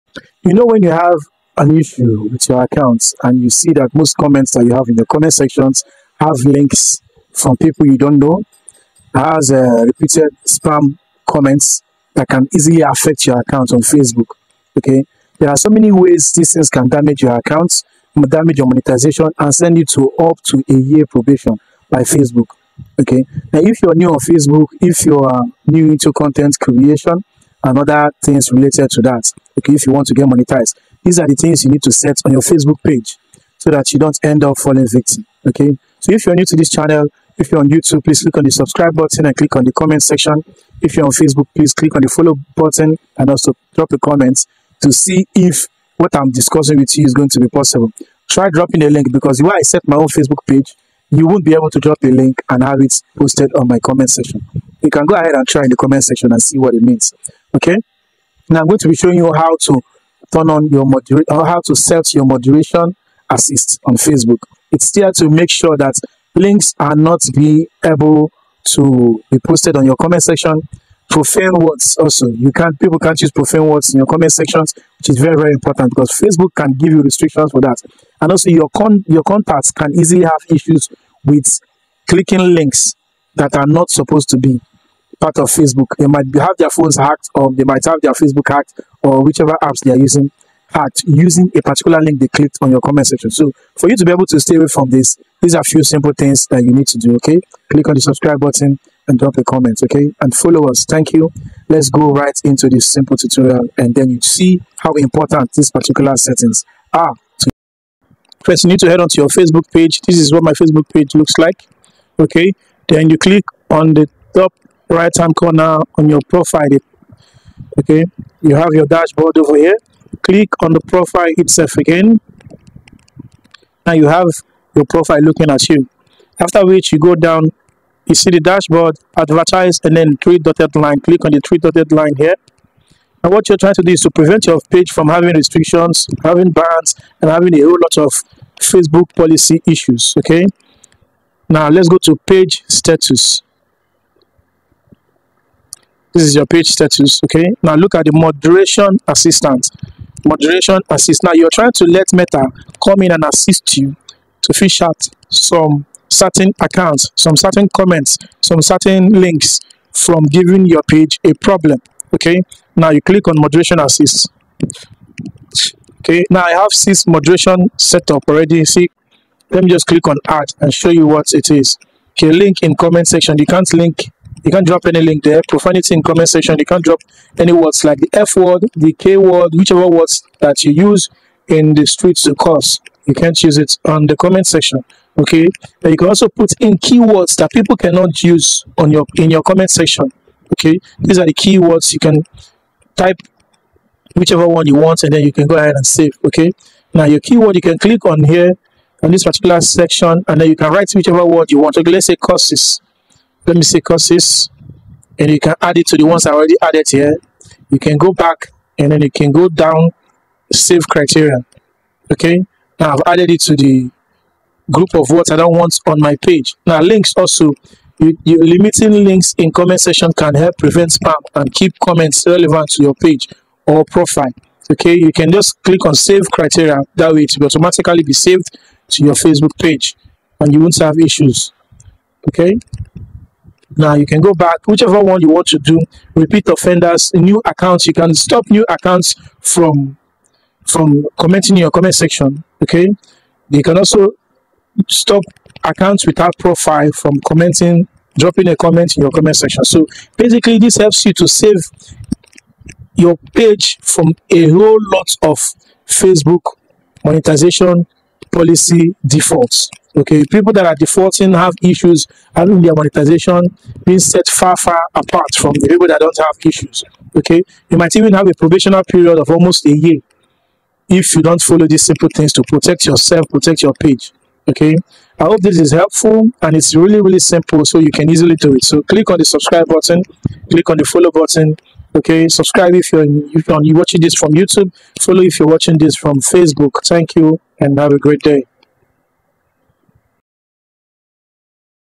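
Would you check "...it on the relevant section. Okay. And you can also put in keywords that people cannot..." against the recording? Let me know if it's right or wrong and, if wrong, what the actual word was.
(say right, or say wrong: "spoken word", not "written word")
wrong: "comment", not "relevant".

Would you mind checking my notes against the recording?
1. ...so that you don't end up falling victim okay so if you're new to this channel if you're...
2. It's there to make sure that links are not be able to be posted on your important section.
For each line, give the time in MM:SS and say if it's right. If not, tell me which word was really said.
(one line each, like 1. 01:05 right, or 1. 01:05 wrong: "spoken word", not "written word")
1. 00:33 right
2. 01:04 wrong: "comment", not "important".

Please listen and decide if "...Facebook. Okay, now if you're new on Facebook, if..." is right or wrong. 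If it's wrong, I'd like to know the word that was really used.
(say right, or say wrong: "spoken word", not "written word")
right.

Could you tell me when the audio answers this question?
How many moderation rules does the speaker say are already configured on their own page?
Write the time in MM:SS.
02:46.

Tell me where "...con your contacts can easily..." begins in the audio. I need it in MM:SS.
01:18.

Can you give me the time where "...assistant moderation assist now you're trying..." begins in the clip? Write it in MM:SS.
02:29.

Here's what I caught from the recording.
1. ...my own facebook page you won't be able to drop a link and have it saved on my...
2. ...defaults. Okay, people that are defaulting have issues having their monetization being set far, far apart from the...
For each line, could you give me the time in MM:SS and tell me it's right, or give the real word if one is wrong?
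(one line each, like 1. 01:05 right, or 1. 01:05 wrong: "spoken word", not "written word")
1. 00:49 wrong: "posted", not "saved"
2. 04:19 right.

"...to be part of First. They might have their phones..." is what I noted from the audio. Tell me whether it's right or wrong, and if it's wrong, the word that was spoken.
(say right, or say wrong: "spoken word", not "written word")
wrong: "Facebook", not "First".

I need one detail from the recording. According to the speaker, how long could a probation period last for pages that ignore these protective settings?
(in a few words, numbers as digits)
almost a year.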